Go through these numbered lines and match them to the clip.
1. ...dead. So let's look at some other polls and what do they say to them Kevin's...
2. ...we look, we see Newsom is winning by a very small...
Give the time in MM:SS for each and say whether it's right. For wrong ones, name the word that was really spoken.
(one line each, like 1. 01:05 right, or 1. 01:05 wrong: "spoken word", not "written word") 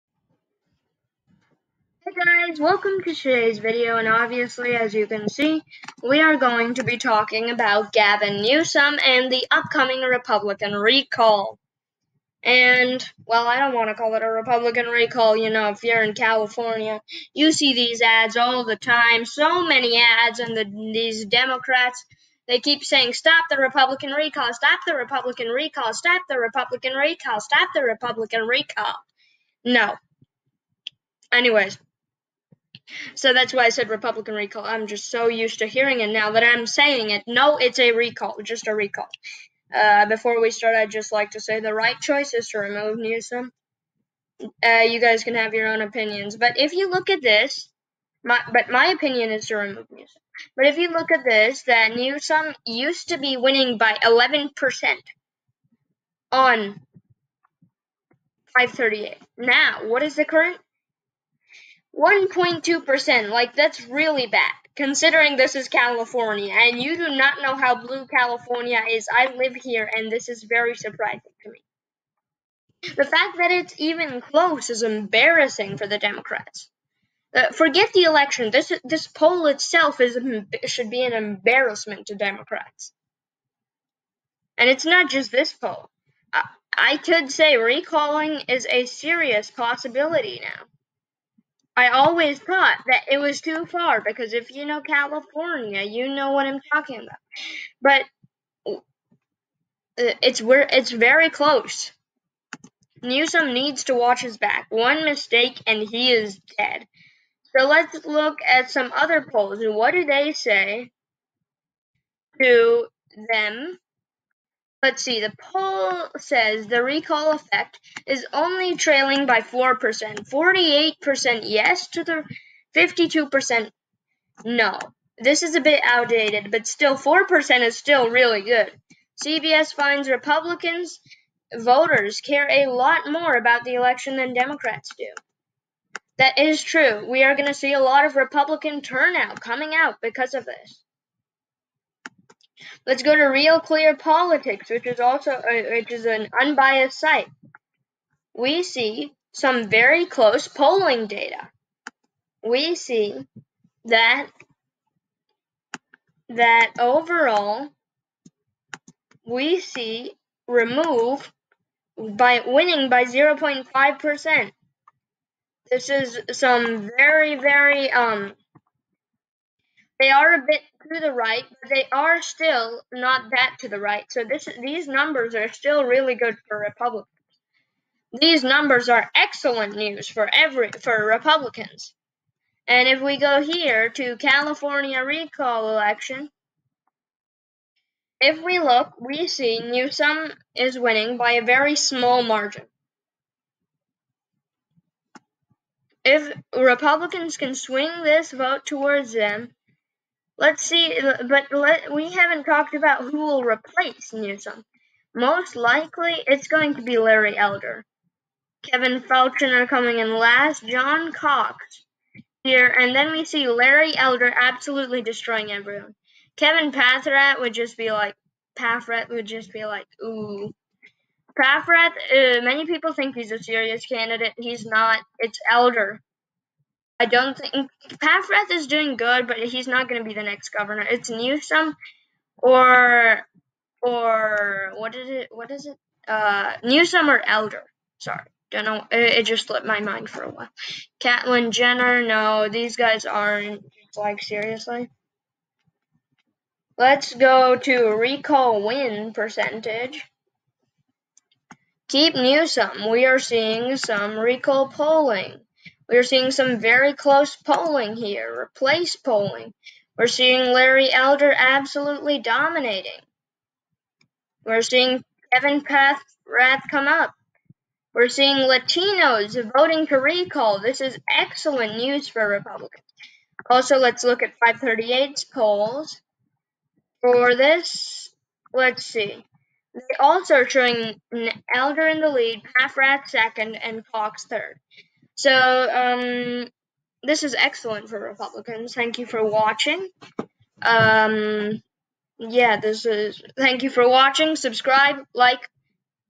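1. 01:46 wrong: "Let", not "Kevin"
2. 03:08 right.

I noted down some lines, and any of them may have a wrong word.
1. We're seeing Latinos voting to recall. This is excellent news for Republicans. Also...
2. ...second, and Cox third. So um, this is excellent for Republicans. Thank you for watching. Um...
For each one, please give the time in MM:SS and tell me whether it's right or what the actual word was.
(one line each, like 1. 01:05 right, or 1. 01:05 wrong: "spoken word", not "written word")
1. 04:27 right
2. 04:43 right.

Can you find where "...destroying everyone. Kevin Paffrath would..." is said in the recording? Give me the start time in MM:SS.
03:35.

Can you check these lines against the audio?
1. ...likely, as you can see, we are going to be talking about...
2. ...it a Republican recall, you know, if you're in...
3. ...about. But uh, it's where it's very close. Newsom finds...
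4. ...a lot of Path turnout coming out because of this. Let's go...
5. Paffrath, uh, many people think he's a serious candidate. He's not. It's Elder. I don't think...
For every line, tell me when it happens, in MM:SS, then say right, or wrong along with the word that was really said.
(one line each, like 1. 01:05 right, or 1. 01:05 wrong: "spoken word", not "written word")
1. 00:04 wrong: "obviously", not "likely"
2. 00:14 right
3. 01:36 wrong: "needs", not "finds"
4. 02:17 wrong: "Republican", not "Path"
5. 03:41 right.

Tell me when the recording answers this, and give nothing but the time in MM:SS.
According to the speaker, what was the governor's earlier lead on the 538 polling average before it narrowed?
00:54.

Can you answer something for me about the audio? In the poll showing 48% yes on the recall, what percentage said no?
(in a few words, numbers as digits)
52%.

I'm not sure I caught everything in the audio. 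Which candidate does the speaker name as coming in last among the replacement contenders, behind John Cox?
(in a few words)
Kevin Faulconer.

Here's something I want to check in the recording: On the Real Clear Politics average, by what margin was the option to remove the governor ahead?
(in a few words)
0.5%.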